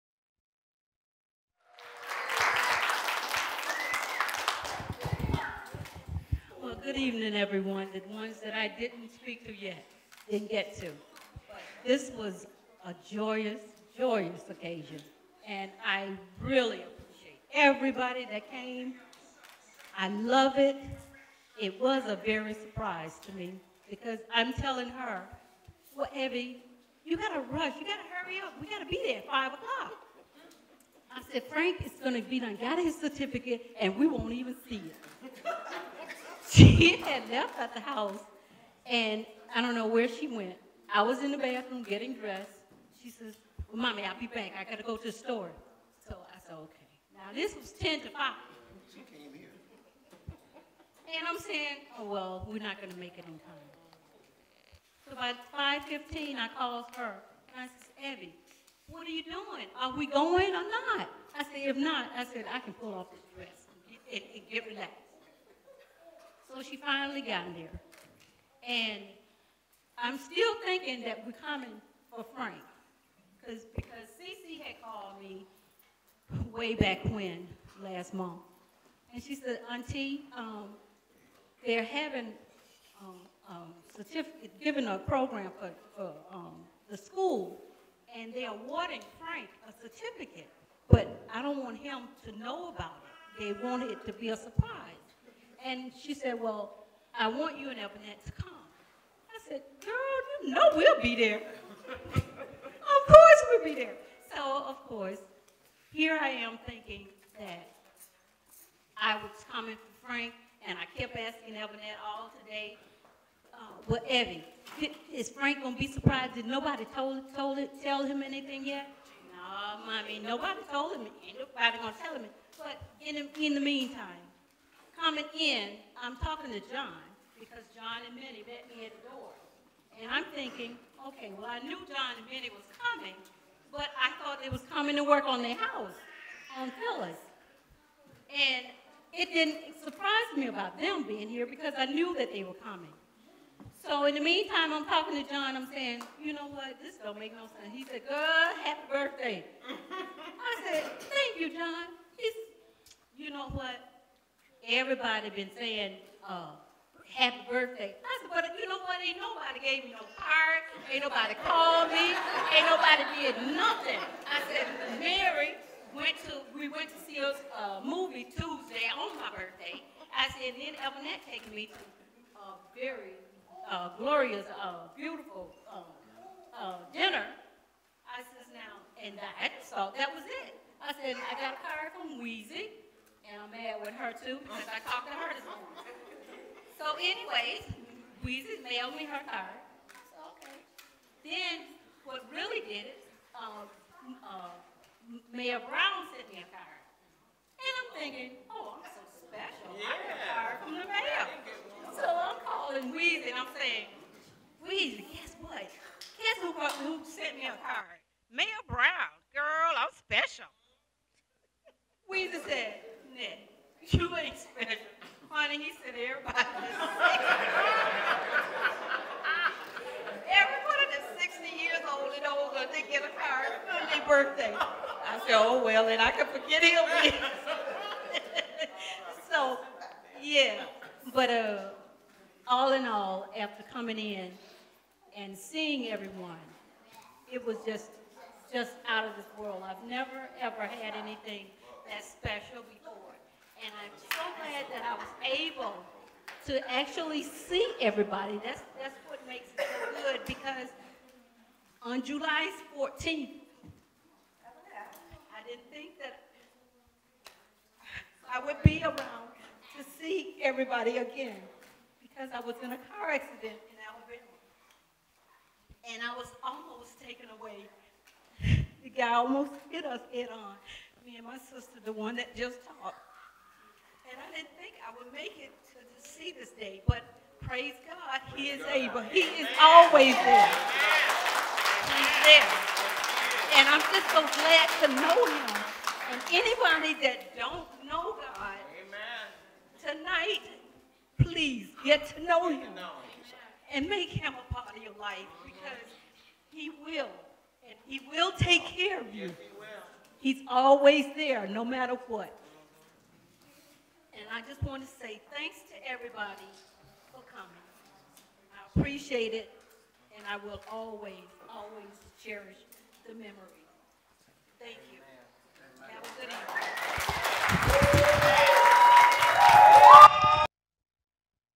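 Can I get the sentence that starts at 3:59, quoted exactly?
I've never, ever had anything that's and I'm so glad that I was able to actually see everybody.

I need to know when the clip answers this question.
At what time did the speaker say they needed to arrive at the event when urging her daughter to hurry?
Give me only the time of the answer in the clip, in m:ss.
0:29.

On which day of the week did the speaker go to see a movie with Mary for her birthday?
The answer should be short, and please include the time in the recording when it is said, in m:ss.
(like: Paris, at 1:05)
Tuesday, at 2:48.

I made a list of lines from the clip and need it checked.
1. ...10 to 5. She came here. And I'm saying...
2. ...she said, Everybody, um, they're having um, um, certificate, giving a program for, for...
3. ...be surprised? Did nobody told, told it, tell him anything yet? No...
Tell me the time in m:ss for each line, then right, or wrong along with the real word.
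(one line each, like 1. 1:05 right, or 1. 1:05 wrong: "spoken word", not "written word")
1. 0:47 right
2. 1:19 wrong: "Auntie", not "Everybody"
3. 1:55 right.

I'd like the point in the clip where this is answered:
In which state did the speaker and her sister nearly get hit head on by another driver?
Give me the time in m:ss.
4:23.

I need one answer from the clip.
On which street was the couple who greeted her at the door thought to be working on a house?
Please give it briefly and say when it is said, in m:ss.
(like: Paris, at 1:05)
Phyllis, at 2:16.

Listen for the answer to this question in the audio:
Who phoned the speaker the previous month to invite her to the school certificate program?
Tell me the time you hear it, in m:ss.
1:14.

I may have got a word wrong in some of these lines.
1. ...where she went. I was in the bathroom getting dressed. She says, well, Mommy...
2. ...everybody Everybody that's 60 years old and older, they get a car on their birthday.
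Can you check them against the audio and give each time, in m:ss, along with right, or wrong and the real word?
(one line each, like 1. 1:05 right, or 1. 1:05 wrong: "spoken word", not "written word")
1. 0:39 right
2. 3:35 right.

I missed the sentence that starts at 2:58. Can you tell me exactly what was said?
I says, now, and I just thought that was it.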